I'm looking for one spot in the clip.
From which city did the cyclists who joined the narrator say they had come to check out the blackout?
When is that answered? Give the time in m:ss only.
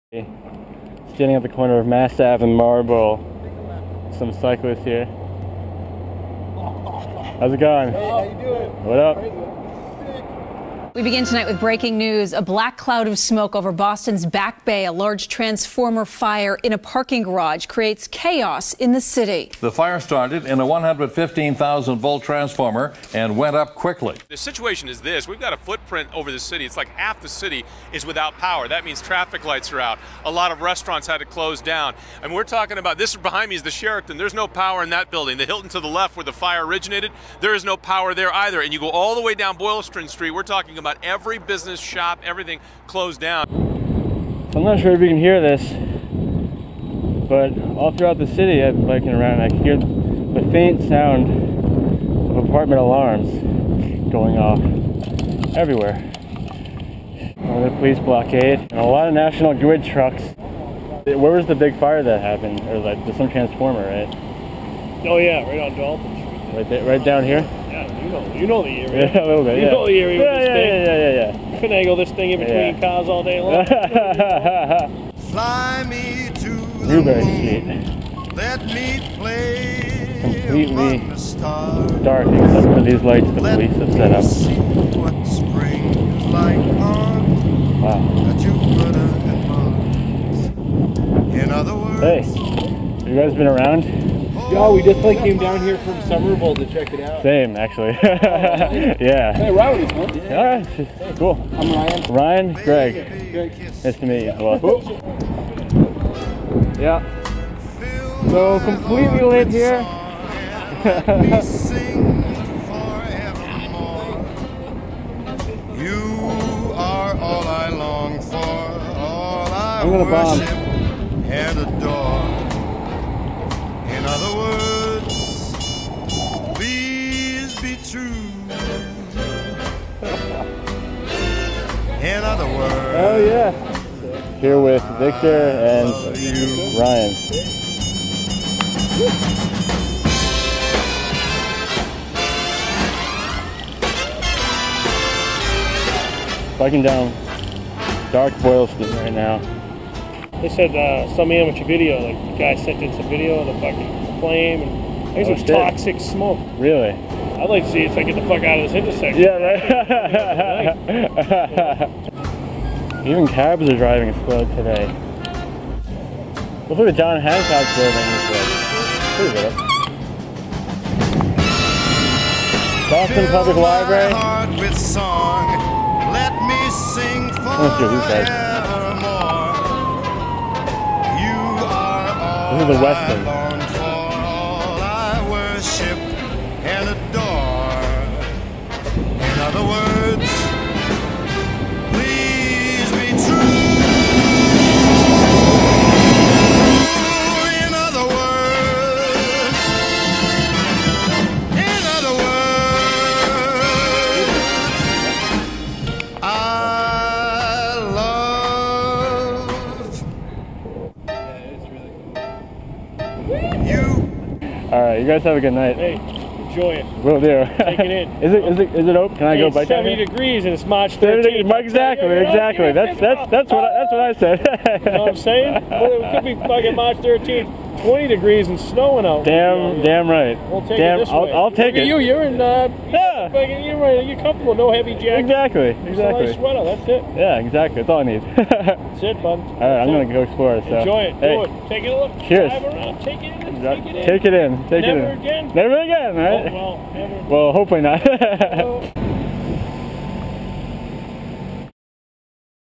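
1:36.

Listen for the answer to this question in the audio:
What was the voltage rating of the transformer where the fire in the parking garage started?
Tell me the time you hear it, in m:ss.
0:20.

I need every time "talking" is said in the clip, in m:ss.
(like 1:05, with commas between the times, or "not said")
0:32, 0:40.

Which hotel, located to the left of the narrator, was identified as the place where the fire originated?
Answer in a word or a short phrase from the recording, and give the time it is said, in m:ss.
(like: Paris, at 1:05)
The Hilton, at 0:35.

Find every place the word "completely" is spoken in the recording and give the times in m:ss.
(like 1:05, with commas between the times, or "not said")
1:20, 1:48.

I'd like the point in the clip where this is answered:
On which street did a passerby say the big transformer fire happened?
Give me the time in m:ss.
1:05.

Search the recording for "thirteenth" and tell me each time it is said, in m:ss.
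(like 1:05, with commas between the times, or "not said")
3:40, 3:46.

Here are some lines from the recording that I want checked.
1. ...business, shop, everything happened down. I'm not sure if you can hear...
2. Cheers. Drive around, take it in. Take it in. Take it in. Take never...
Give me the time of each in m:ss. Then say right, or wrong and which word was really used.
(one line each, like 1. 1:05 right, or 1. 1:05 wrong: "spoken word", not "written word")
1. 0:41 wrong: "closed", not "happened"
2. 4:02 right.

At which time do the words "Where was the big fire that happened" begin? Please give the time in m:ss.
1:01.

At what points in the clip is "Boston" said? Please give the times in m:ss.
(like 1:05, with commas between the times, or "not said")
0:13, 2:52.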